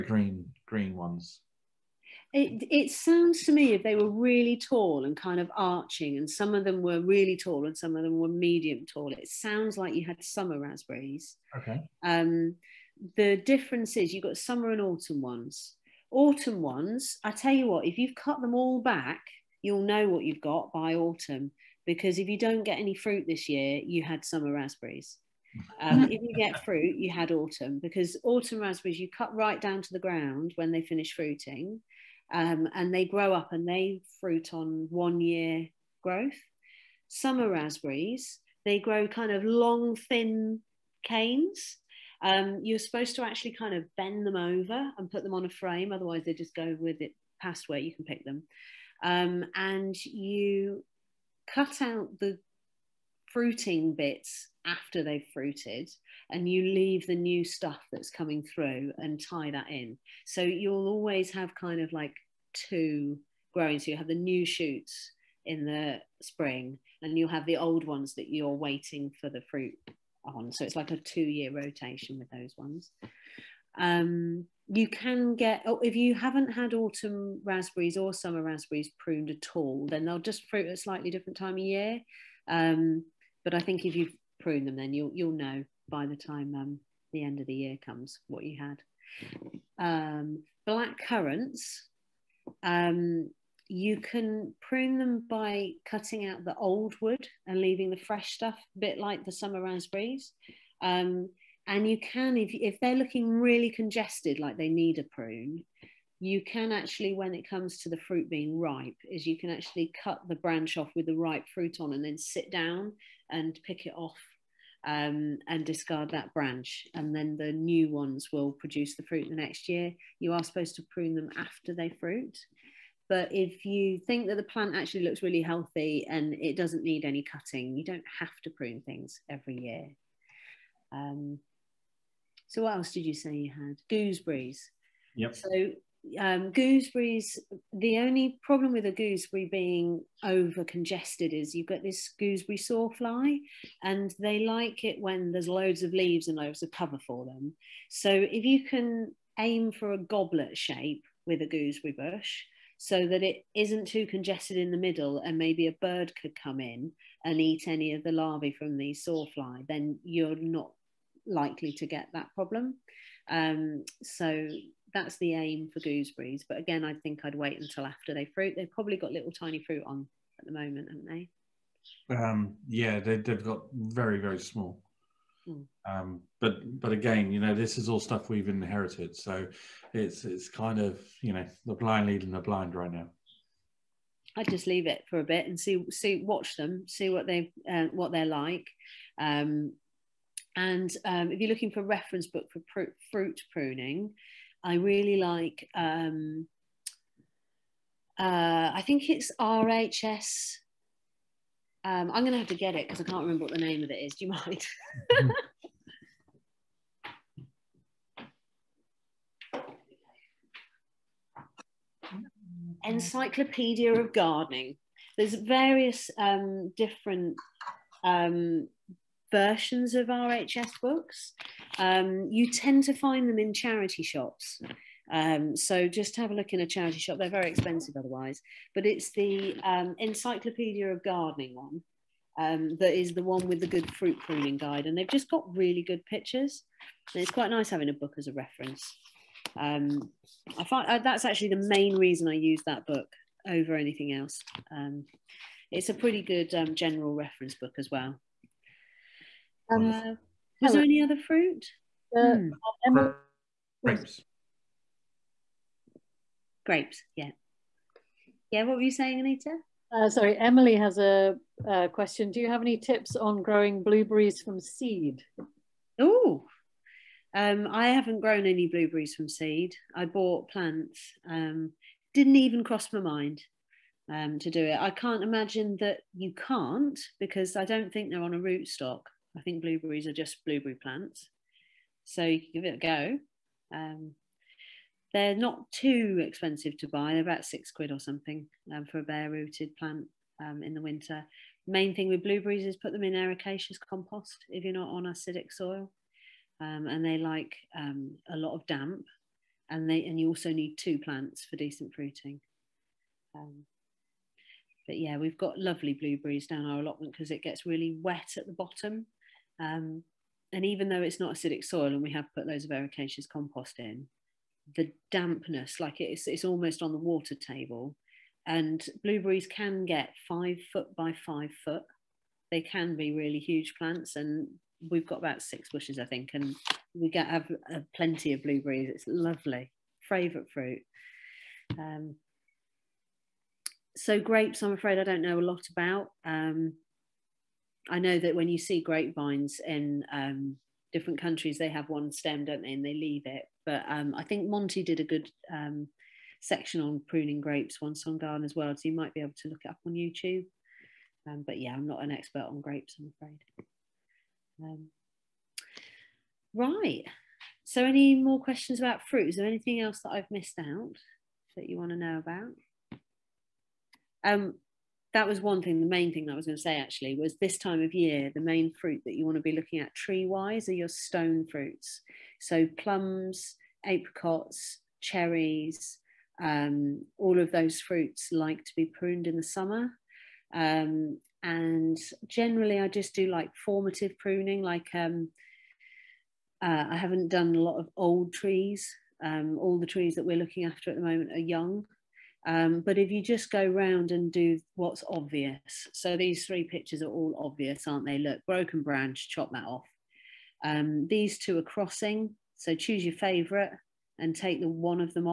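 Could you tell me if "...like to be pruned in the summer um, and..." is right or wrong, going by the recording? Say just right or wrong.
right.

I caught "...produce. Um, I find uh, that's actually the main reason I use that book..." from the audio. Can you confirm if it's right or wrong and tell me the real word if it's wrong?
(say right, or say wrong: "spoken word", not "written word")
wrong: "reference", not "produce".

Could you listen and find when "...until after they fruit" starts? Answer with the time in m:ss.
2:47.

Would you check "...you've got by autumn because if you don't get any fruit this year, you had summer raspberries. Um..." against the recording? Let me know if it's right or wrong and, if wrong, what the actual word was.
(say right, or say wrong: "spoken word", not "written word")
right.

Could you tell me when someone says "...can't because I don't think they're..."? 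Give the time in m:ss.
4:36.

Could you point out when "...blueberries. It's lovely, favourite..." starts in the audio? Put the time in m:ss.
5:28.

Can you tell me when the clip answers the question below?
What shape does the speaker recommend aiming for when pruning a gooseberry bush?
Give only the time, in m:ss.
2:29.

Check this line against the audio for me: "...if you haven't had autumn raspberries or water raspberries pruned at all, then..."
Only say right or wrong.
wrong.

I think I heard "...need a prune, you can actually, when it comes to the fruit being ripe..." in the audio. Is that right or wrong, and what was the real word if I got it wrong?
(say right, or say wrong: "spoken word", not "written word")
right.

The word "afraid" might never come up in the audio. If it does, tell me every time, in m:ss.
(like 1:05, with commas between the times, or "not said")
5:34, 5:53.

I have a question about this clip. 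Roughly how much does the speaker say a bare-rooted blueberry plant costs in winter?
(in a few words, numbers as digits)
6 pounds.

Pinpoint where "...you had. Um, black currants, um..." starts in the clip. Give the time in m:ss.
1:28.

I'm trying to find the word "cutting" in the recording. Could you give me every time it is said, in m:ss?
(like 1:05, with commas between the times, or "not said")
1:35, 2:07.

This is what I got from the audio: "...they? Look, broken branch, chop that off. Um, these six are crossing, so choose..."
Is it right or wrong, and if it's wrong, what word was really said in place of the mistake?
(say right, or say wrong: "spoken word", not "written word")
wrong: "two", not "six".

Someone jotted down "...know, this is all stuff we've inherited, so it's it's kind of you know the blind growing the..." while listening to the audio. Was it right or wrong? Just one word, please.
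wrong.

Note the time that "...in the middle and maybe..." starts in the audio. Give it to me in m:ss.
2:34.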